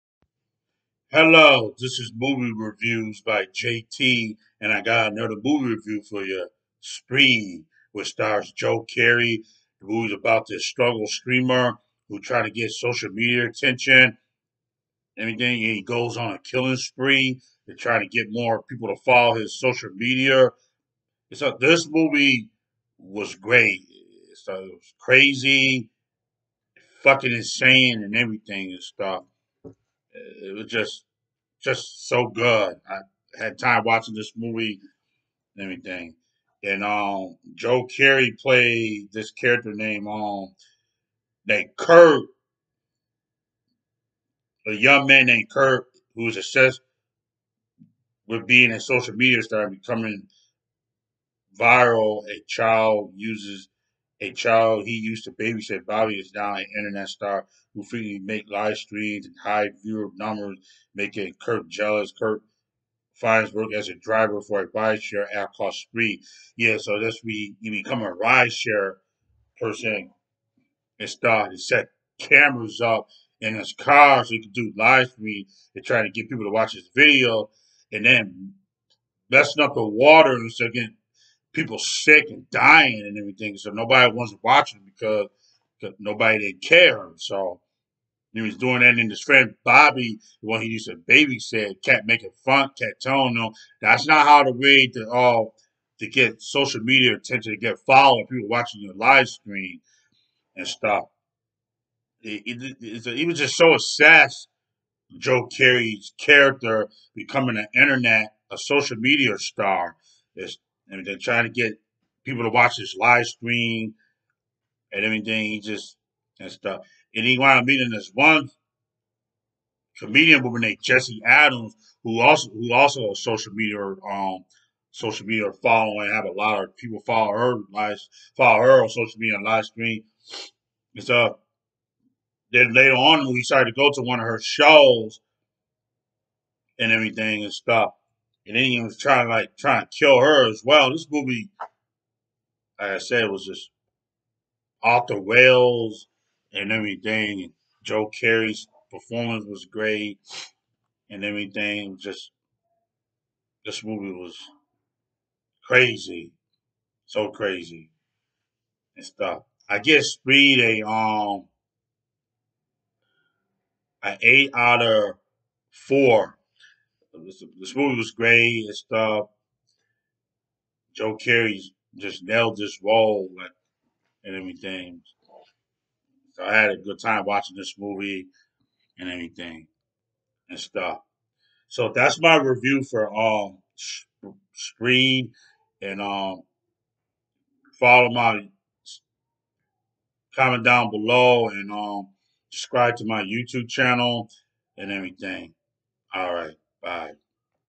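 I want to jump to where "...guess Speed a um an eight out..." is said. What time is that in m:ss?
2:39.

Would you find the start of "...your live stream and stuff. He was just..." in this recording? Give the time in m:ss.
1:38.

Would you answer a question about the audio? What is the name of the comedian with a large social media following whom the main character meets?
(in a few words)
Jessie Adams.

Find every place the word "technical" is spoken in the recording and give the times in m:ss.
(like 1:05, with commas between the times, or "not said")
not said.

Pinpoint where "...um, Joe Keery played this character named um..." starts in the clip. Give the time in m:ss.
0:36.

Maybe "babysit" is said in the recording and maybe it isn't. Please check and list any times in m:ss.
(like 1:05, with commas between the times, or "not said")
0:55, 1:30.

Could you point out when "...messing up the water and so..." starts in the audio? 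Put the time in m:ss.
1:19.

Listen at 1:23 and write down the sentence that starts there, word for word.
So nobody wants watching because, because nobody didn't care.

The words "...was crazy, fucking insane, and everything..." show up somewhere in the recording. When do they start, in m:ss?
0:24.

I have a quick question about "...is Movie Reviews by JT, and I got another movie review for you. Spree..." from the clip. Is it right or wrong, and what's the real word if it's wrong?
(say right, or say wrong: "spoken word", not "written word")
right.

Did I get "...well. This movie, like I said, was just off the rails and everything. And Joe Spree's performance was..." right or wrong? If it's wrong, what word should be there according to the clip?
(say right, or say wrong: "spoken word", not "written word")
wrong: "Keery", not "Spree".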